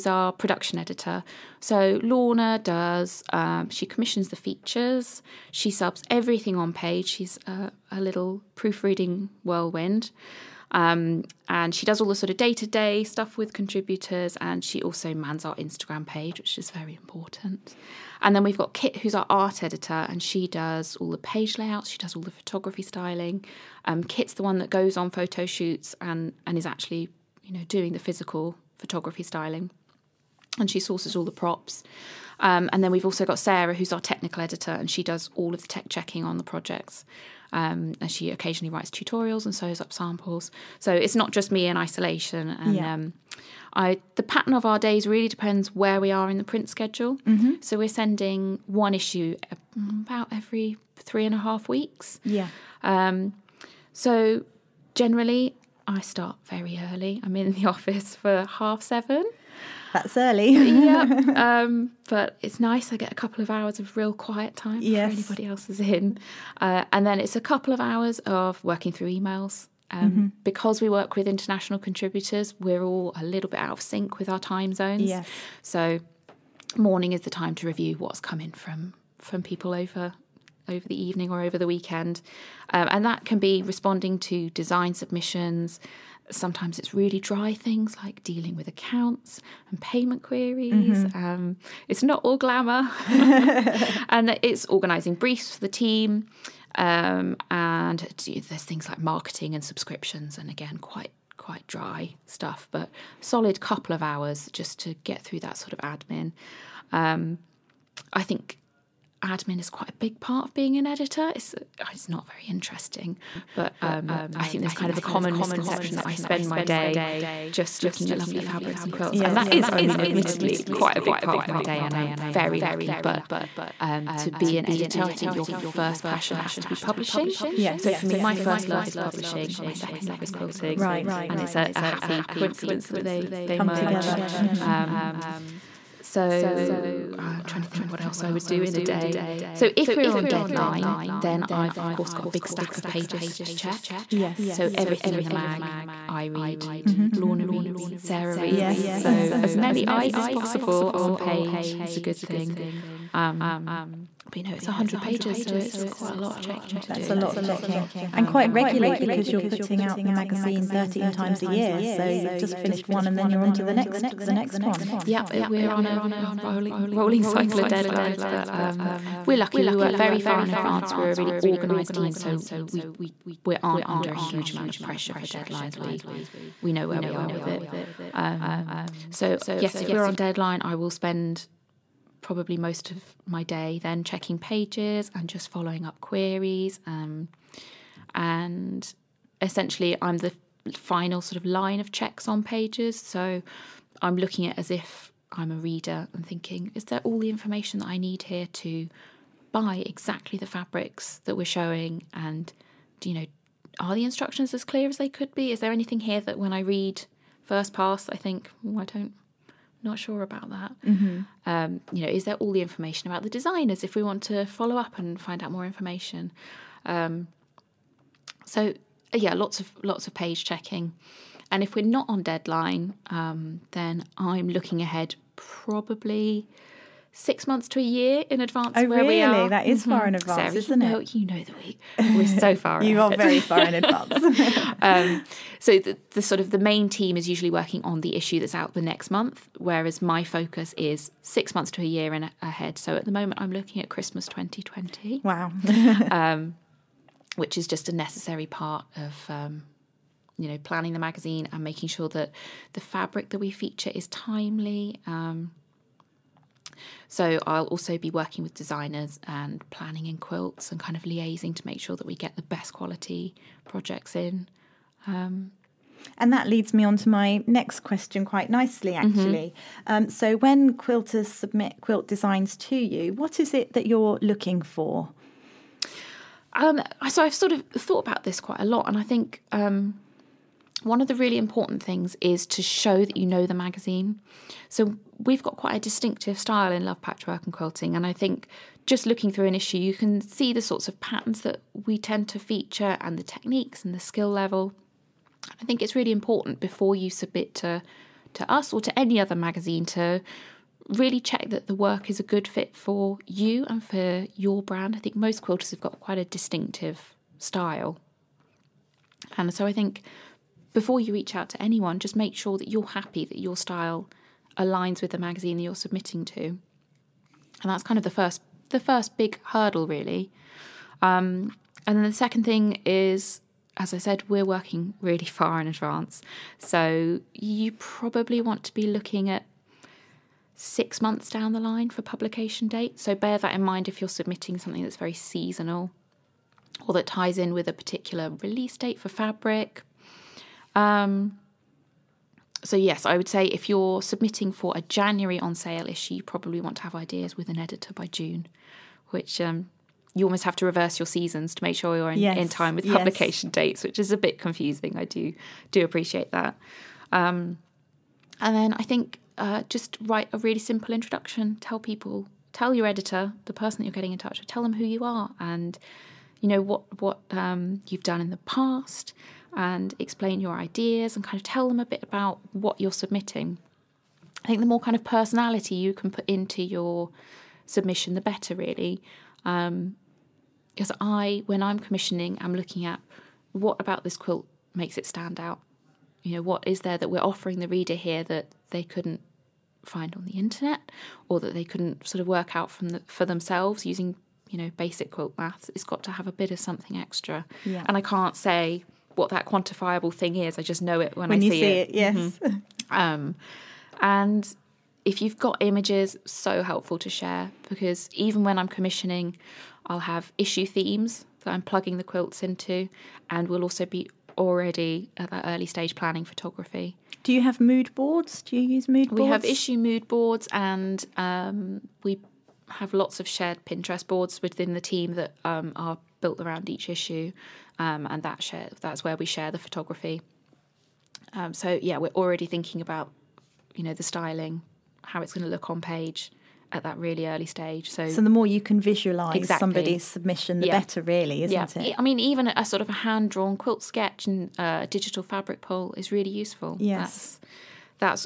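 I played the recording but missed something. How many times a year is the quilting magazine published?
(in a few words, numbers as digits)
13.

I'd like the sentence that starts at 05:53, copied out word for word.
dates, which is a bit confusing.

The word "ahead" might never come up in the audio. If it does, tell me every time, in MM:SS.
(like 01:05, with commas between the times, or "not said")
03:44, 04:02.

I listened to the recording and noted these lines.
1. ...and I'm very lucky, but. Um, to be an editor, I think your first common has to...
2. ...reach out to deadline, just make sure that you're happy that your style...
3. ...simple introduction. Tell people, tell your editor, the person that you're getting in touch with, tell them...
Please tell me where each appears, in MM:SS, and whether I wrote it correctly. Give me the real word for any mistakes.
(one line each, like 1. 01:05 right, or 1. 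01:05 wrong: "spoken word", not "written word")
1. 02:01 wrong: "passion", not "common"
2. 05:11 wrong: "anyone", not "deadline"
3. 06:00 right.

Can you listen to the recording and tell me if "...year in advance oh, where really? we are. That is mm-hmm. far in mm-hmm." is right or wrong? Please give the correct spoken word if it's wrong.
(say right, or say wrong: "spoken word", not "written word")
right.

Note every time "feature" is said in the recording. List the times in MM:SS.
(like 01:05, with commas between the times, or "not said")
00:04, 04:13, 04:52.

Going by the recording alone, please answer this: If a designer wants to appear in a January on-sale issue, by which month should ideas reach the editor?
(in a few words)
June.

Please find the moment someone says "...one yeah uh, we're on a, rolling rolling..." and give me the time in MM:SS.
02:44.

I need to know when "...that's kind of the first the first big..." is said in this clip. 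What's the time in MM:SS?
05:17.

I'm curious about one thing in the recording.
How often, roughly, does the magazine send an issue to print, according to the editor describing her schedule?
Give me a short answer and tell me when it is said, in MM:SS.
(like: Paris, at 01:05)
every 3.5 weeks, at 00:50.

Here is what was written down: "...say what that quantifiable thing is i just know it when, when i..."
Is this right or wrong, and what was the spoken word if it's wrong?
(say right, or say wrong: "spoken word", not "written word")
right.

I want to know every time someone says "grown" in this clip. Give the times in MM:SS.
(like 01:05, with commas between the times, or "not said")
not said.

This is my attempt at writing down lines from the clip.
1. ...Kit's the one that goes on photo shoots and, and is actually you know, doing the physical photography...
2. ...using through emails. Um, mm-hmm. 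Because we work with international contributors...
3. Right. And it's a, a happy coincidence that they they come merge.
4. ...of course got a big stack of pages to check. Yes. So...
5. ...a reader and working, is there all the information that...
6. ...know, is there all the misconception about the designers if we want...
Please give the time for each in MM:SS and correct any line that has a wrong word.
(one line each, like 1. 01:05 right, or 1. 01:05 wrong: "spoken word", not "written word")
1. 00:24 right
2. 01:08 wrong: "working", not "using"
3. 02:10 right
4. 02:21 right
5. 03:15 wrong: "thinking", not "working"
6. 03:32 wrong: "information", not "misconception".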